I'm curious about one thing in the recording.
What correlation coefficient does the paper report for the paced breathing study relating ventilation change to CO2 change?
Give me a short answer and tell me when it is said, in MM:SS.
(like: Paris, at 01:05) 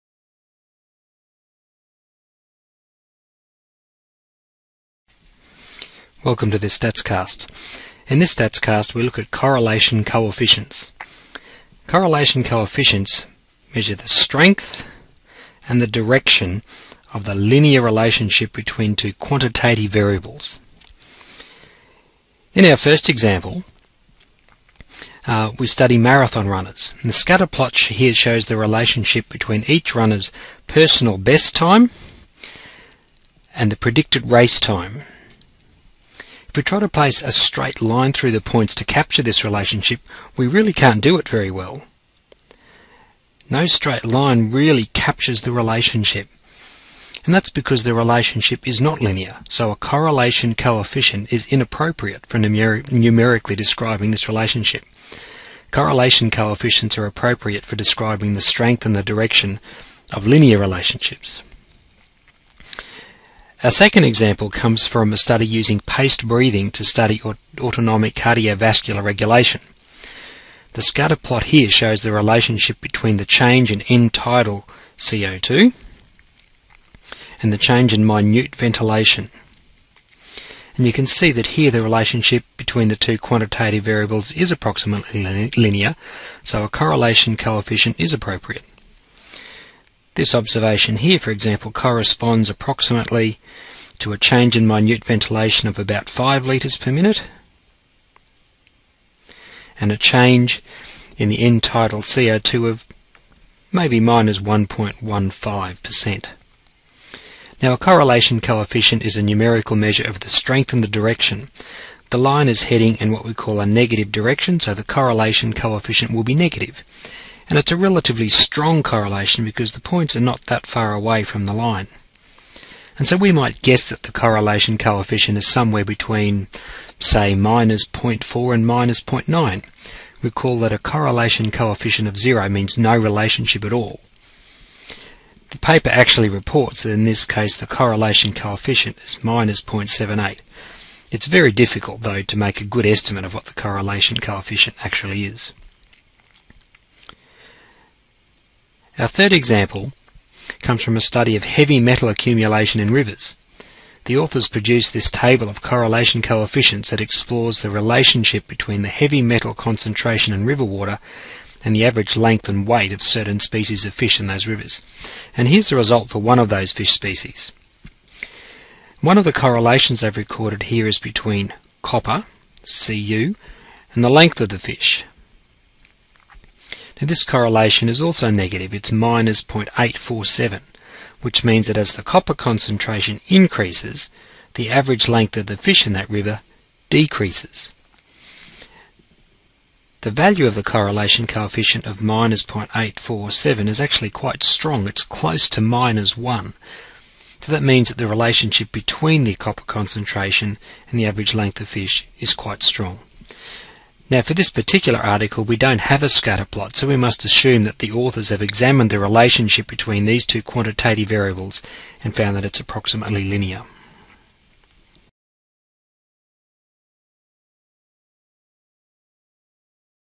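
-0.78, at 02:19.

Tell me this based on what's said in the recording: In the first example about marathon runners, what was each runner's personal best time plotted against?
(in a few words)
Predicted race time.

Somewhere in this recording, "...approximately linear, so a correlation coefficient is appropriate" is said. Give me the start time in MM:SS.
01:24.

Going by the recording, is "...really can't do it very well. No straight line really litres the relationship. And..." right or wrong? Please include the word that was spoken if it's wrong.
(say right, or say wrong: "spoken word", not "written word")
wrong: "captures", not "litres".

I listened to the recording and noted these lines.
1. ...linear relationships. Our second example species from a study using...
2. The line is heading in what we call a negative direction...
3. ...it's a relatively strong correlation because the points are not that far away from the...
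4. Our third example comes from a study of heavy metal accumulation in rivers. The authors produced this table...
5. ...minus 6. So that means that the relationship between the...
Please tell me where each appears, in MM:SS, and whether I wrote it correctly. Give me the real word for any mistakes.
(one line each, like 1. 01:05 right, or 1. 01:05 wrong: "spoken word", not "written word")
1. 01:00 wrong: "comes", not "species"
2. 01:52 right
3. 01:57 right
4. 02:29 right
5. 03:15 wrong: "1", not "6".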